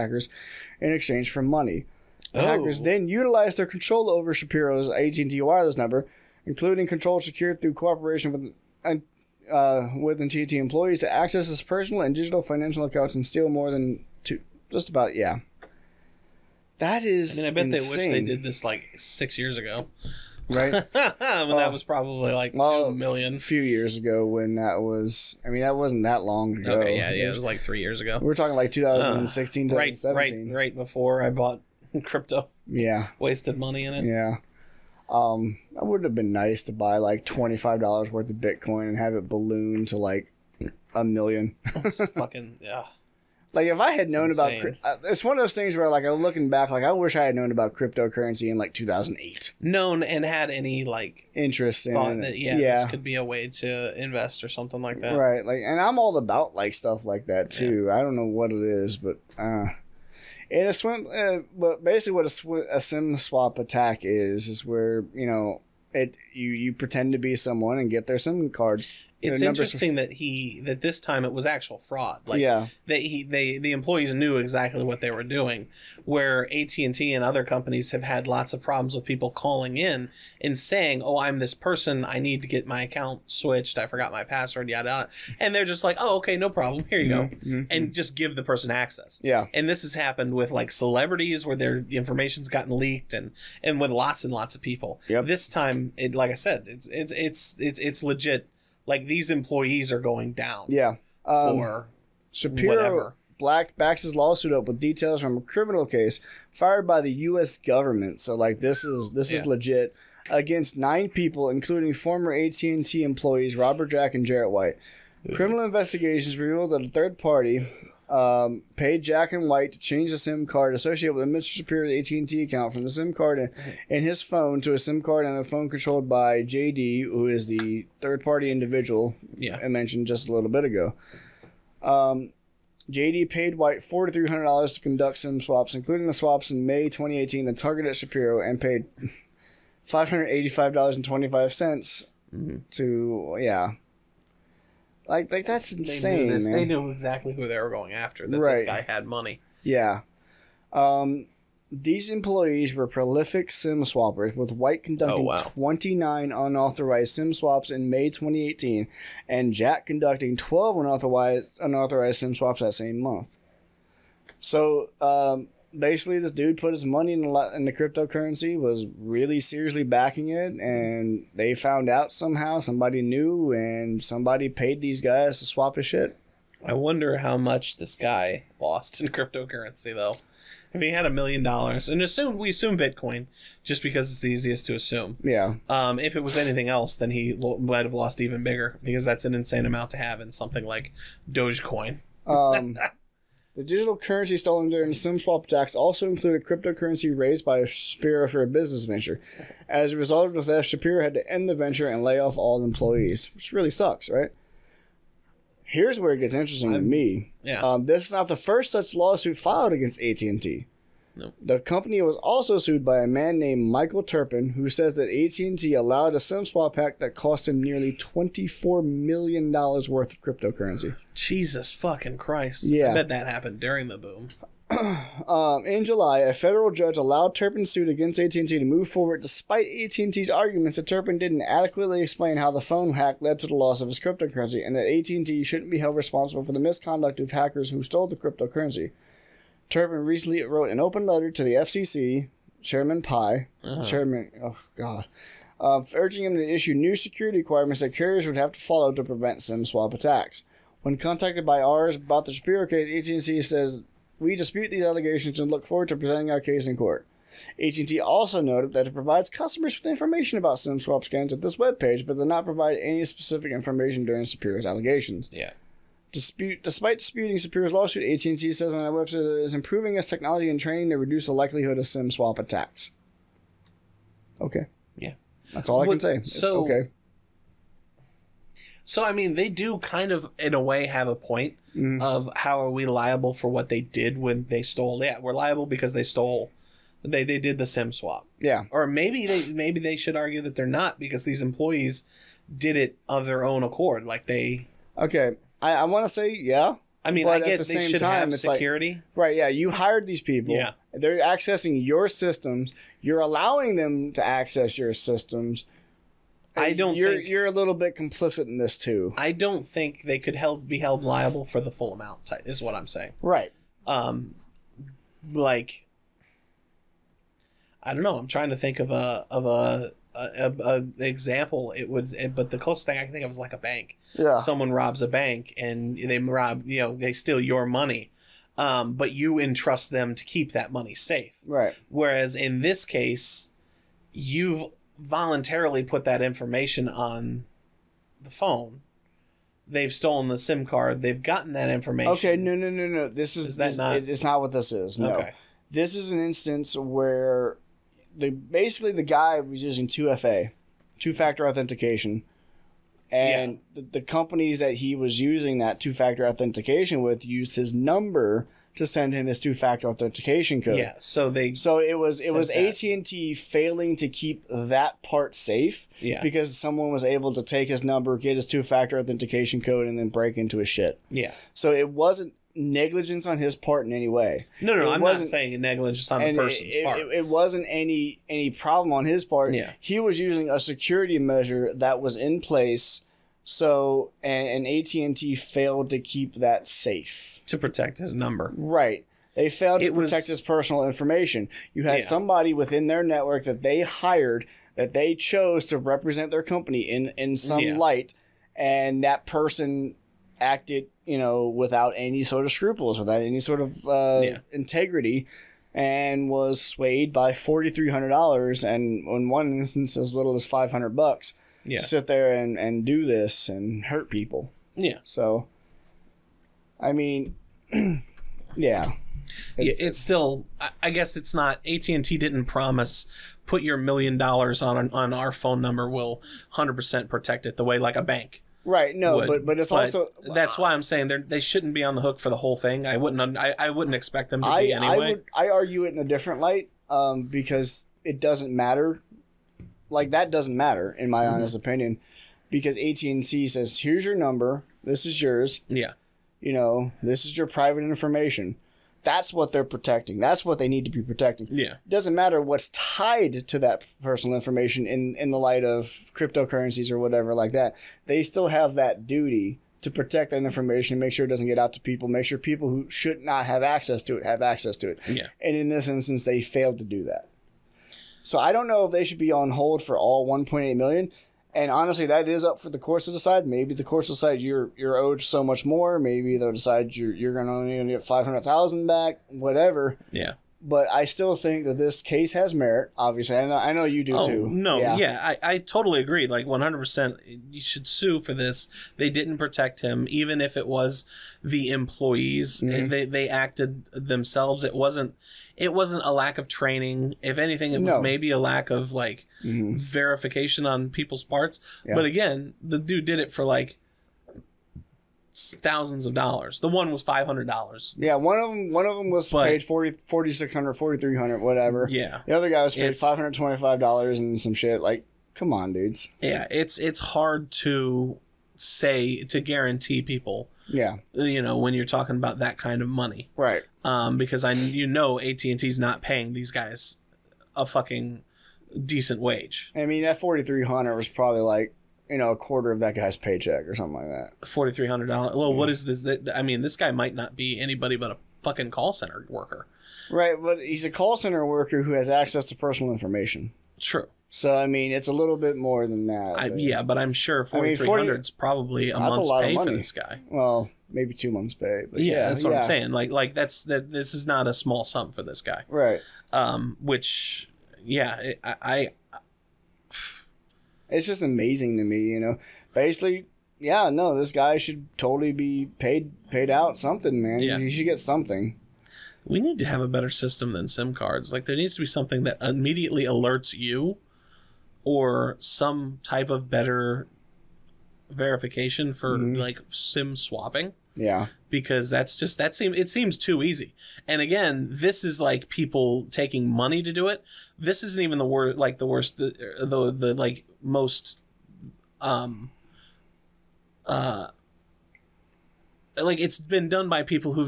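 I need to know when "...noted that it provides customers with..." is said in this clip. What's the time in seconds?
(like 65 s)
258 s.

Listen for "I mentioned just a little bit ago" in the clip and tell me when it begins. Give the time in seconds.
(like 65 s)
129 s.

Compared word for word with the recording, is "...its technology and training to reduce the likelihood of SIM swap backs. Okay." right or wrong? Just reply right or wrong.
wrong.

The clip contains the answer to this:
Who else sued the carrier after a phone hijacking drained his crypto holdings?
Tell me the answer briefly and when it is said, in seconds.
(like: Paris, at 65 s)
Michael Turpin, at 213 s.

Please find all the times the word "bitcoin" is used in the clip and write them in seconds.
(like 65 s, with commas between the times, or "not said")
38 s, 182 s.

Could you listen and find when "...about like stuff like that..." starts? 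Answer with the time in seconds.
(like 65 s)
56 s.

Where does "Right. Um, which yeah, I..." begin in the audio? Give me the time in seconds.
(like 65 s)
555 s.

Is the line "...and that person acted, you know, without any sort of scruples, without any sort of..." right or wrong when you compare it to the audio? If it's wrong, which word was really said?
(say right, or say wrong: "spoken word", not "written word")
right.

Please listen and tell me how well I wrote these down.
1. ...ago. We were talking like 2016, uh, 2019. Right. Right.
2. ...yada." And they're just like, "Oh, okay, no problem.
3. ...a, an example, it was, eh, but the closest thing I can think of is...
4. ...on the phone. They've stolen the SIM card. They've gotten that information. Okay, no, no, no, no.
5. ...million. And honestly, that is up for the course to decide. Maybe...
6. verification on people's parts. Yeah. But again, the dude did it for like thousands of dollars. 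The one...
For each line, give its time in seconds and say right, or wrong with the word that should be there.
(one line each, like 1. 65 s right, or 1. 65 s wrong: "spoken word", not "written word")
1. 28 s wrong: "2017", not "2019"
2. 84 s right
3. 320 s right
4. 336 s right
5. 470 s right
6. 499 s right.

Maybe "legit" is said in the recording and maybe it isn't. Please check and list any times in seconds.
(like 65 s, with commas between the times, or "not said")
98 s, 109 s.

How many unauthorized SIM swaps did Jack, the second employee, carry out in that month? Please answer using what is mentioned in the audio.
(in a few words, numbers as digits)
12.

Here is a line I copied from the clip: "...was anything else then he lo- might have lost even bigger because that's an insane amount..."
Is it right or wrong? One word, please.
right.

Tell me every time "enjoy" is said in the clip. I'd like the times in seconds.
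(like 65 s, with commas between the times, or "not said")
not said.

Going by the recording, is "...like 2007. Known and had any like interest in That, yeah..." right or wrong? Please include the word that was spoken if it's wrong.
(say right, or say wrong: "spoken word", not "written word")
wrong: "2008", not "2007".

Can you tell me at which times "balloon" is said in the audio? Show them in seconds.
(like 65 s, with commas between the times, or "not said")
39 s.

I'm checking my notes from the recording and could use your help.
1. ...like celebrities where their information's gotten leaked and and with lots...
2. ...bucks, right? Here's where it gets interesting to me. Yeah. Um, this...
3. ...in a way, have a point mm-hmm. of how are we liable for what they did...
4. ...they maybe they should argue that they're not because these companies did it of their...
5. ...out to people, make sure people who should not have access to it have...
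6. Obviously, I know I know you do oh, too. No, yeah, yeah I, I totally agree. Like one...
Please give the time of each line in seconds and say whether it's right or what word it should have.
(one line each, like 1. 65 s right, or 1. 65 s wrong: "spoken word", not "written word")
1. 90 s right
2. 203 s wrong: "sucks", not "bucks"
3. 280 s right
4. 289 s wrong: "employees", not "companies"
5. 461 s right
6. 482 s right.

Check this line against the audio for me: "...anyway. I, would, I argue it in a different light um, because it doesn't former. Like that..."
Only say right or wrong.
wrong.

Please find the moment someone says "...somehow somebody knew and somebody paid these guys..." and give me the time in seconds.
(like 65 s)
172 s.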